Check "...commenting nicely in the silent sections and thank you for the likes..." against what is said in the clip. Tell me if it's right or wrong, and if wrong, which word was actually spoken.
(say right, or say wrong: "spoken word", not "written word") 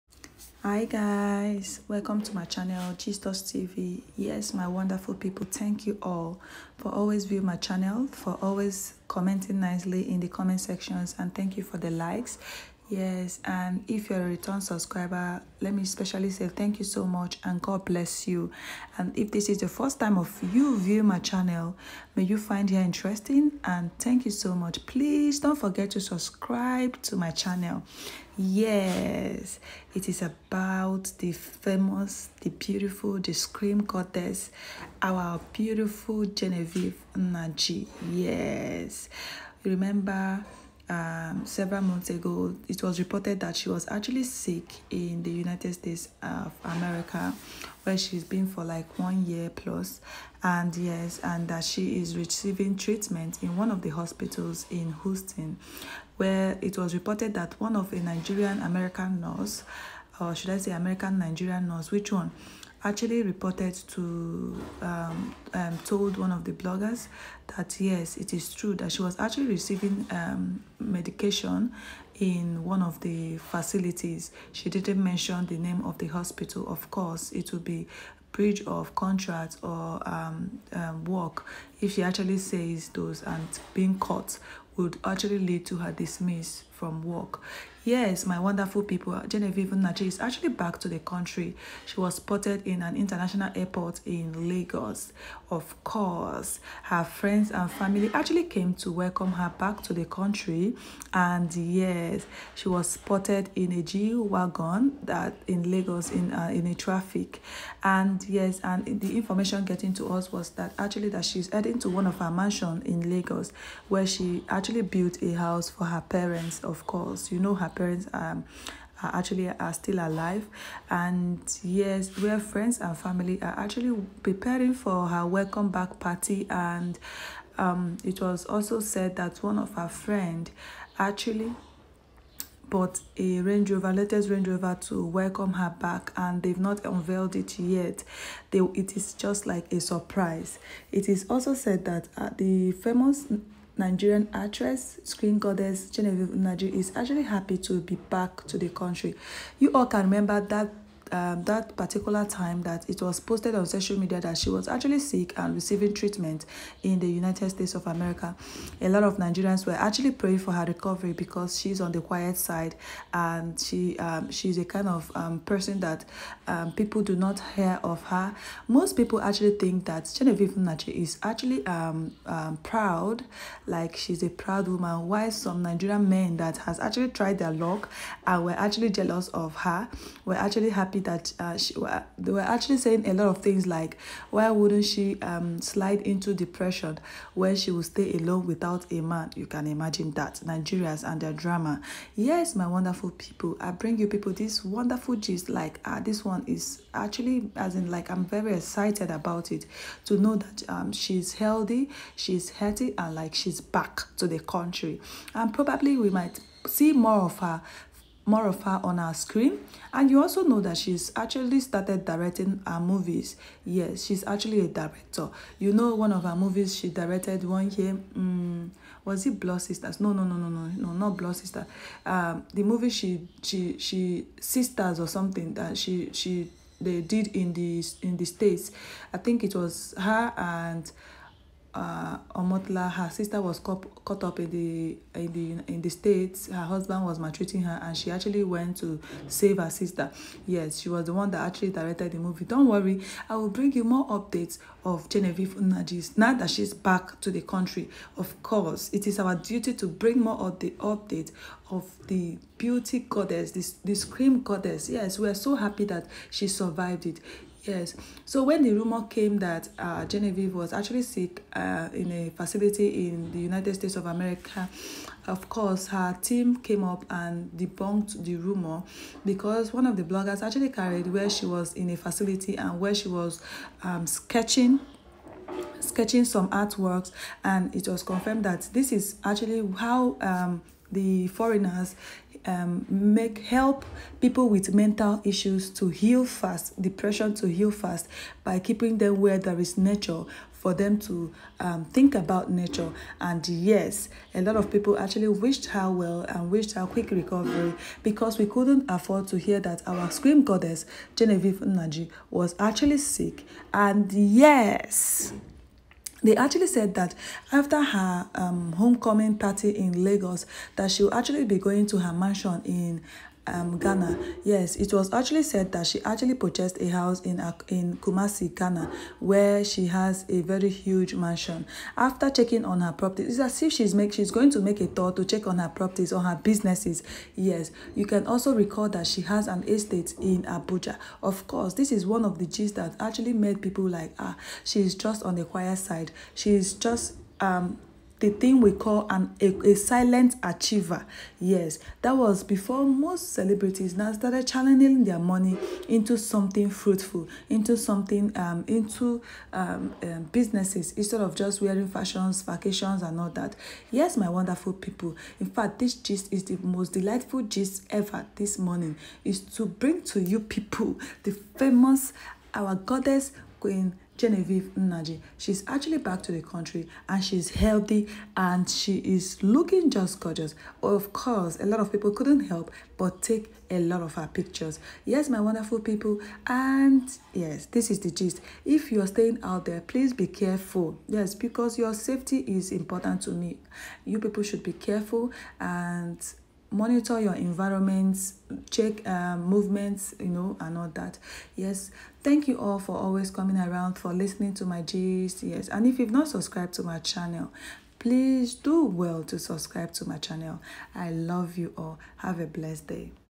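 wrong: "comment", not "silent".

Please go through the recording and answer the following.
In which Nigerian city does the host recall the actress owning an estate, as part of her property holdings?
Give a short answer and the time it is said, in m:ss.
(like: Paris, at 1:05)
Abuja, at 5:30.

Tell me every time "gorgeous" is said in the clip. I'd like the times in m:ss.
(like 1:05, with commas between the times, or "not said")
6:10.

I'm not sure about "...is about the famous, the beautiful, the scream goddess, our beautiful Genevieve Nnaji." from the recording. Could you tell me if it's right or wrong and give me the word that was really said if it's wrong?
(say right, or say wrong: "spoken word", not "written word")
right.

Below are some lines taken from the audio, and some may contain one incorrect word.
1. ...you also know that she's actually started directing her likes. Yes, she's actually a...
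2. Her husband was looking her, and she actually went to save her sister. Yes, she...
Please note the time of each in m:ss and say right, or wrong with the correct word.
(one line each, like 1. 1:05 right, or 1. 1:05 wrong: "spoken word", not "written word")
1. 3:30 wrong: "movies", not "likes"
2. 3:56 wrong: "maltreating", not "looking".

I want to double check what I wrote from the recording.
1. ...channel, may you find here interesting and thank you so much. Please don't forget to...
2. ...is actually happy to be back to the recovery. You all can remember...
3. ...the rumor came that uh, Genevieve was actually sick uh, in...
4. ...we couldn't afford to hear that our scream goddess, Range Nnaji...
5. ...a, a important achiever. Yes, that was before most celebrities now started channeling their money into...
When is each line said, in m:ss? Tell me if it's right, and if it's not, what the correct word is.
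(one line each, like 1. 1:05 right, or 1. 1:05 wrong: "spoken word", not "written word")
1. 0:21 right
2. 2:26 wrong: "country", not "recovery"
3. 4:18 right
4. 4:58 wrong: "Genevieve", not "Range"
5. 5:39 wrong: "silent", not "important".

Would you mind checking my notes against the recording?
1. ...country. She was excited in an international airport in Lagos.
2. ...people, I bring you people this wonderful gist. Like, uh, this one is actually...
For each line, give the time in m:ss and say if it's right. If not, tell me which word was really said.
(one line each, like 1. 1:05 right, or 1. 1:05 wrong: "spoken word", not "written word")
1. 1:30 wrong: "spotted", not "excited"
2. 3:13 right.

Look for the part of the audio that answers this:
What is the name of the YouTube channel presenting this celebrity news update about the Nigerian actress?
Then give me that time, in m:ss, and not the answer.
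0:02.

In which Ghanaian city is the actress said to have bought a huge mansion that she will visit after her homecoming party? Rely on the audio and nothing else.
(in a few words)
Kumasi.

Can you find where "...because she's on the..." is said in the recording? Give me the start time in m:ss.
2:41.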